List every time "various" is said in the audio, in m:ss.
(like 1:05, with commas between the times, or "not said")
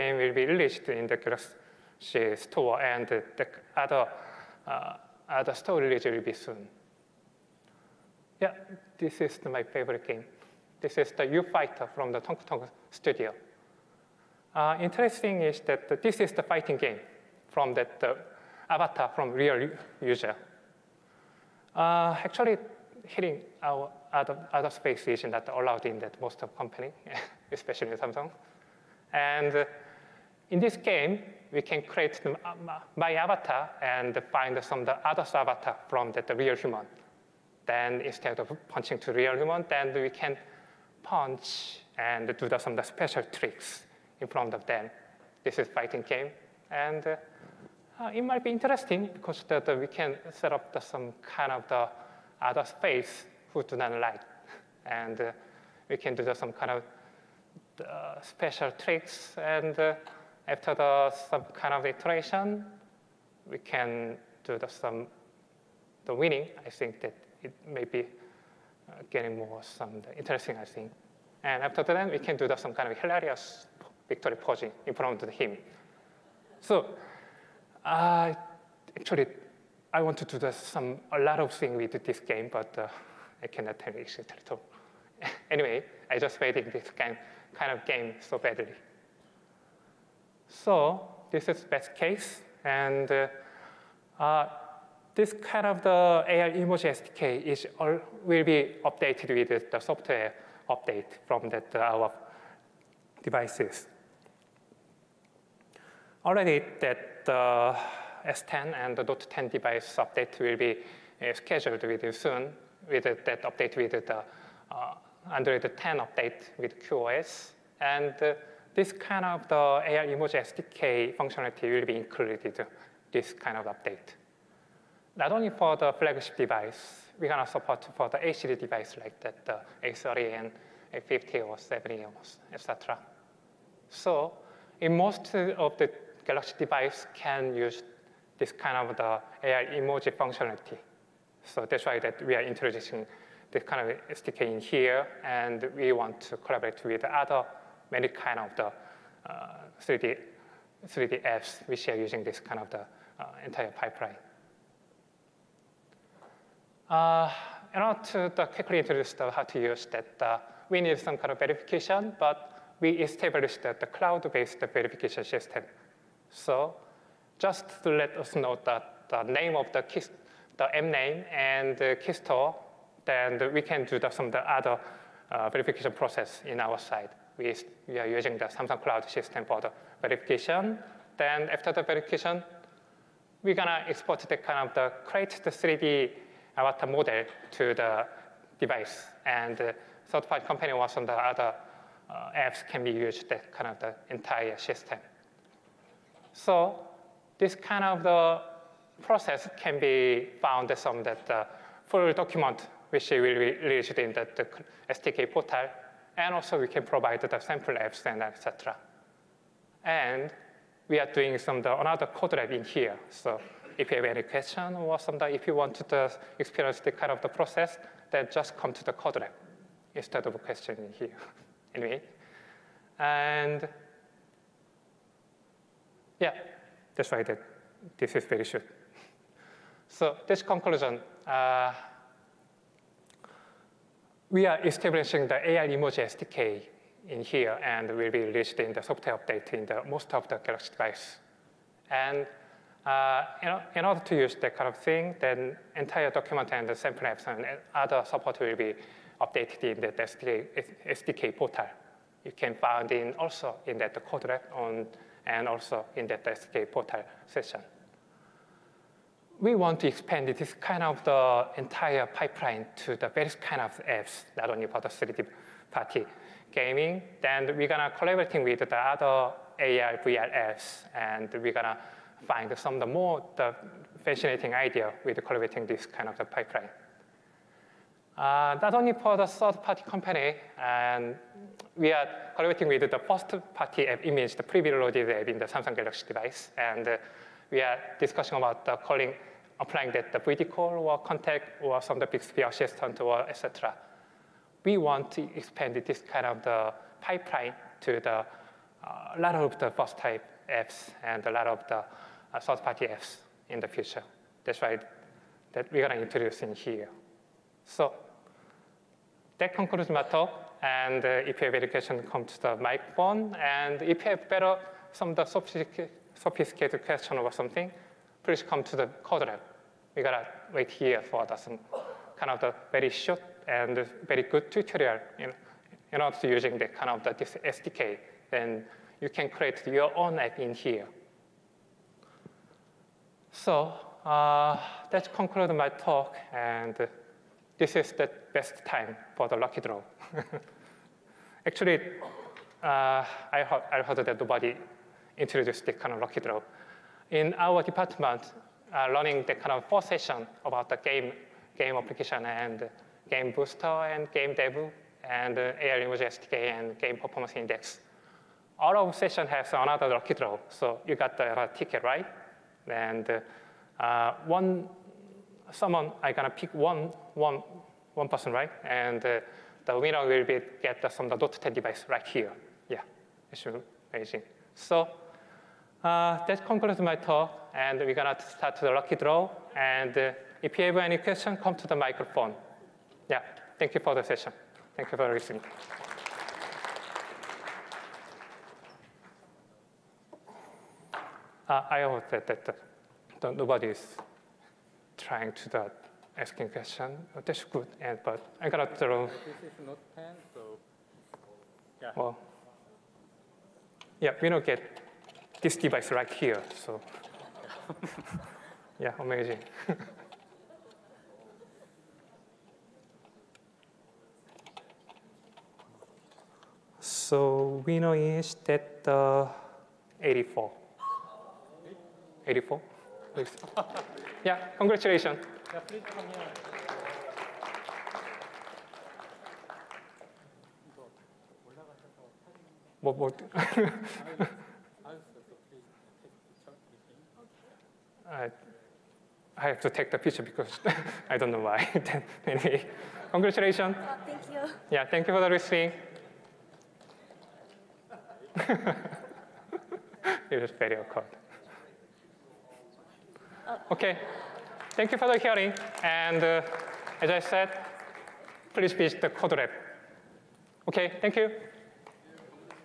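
4:23.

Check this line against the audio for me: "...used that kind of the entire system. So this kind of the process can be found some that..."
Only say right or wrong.
right.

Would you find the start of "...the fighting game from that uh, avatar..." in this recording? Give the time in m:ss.
0:16.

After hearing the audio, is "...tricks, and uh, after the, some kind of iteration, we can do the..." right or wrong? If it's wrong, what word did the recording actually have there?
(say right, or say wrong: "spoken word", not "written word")
right.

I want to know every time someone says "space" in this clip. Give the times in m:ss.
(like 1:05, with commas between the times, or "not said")
0:24, 0:52.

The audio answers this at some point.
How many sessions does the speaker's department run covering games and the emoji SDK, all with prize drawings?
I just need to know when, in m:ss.
5:49.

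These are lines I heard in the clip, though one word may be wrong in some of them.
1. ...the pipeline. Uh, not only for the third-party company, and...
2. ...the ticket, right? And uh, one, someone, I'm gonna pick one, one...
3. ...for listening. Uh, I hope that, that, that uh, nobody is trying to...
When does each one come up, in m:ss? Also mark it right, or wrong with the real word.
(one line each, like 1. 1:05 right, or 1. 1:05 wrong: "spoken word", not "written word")
1. 4:36 right
2. 6:01 right
3. 6:24 right.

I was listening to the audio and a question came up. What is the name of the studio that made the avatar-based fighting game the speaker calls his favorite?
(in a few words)
Tong Tong Studio.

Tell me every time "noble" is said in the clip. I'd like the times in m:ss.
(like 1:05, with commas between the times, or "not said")
not said.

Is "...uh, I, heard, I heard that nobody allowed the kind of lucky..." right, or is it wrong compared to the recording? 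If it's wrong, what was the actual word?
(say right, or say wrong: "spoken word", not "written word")
wrong: "introduced", not "allowed".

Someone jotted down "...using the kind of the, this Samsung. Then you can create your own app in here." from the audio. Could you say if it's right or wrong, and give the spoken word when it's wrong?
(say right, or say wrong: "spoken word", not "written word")
wrong: "SDK", not "Samsung".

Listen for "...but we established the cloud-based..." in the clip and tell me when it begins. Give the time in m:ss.
2:42.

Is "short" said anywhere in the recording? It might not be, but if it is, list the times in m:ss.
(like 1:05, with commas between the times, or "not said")
3:48, 5:22.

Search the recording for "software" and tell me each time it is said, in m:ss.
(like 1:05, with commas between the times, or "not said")
1:39, 3:58.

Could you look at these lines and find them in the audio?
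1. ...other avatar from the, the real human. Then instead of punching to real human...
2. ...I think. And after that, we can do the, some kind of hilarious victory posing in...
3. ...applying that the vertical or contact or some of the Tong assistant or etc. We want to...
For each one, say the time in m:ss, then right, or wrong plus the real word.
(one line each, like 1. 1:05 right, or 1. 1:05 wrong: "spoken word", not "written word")
1. 0:35 right
2. 1:10 right
3. 4:49 wrong: "Bixby", not "Tong".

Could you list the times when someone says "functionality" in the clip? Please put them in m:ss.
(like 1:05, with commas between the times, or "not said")
2:01, 2:20.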